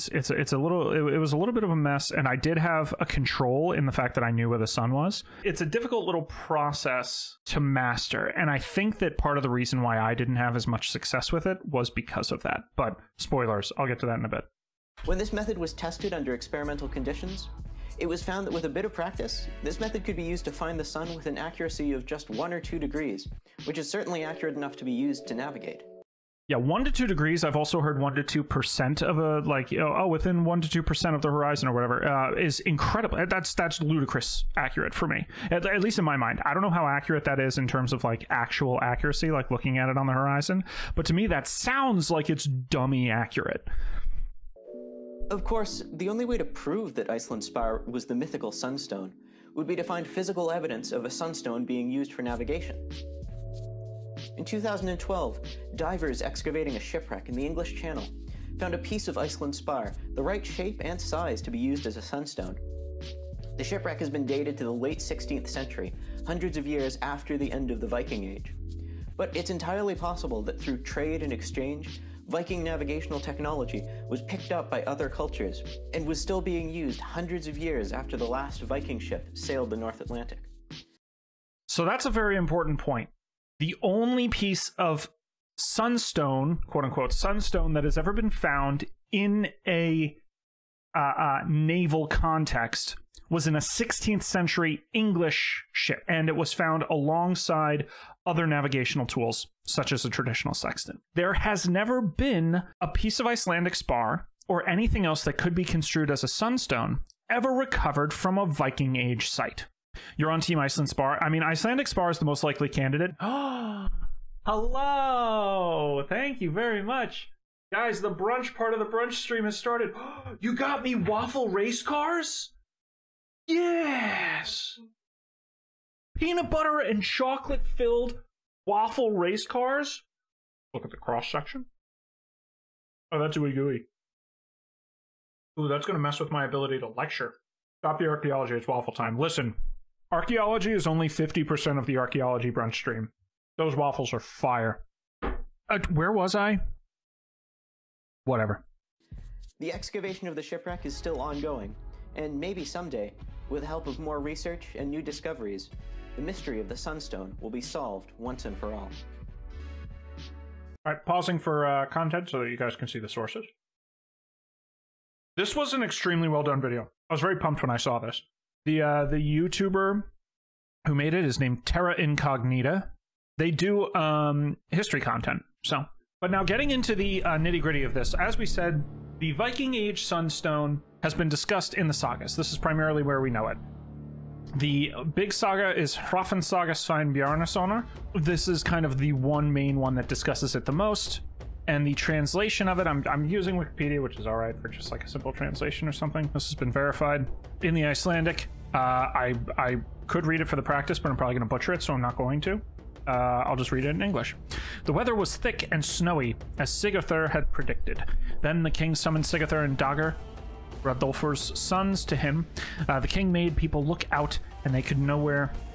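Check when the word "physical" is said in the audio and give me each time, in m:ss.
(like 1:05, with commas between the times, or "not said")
0:50.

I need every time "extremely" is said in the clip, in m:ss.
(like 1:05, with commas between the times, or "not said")
2:45.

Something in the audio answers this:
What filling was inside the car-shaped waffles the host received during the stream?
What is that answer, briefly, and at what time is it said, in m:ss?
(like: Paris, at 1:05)
Peanut butter and chocolate, at 2:06.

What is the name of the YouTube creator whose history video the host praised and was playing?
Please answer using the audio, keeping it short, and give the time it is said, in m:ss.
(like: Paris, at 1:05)
Terra Incognita, at 2:51.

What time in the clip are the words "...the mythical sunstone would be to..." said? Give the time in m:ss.
0:48.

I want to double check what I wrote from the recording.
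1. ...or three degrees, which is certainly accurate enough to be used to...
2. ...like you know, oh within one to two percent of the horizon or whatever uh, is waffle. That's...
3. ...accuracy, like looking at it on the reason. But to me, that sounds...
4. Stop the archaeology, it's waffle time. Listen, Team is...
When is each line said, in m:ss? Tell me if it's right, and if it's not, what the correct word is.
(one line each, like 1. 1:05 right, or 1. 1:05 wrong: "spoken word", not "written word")
1. 0:22 wrong: "two", not "three"
2. 0:29 wrong: "incredible", not "waffle"
3. 0:38 wrong: "horizon", not "reason"
4. 2:17 wrong: "Archaeology", not "Team".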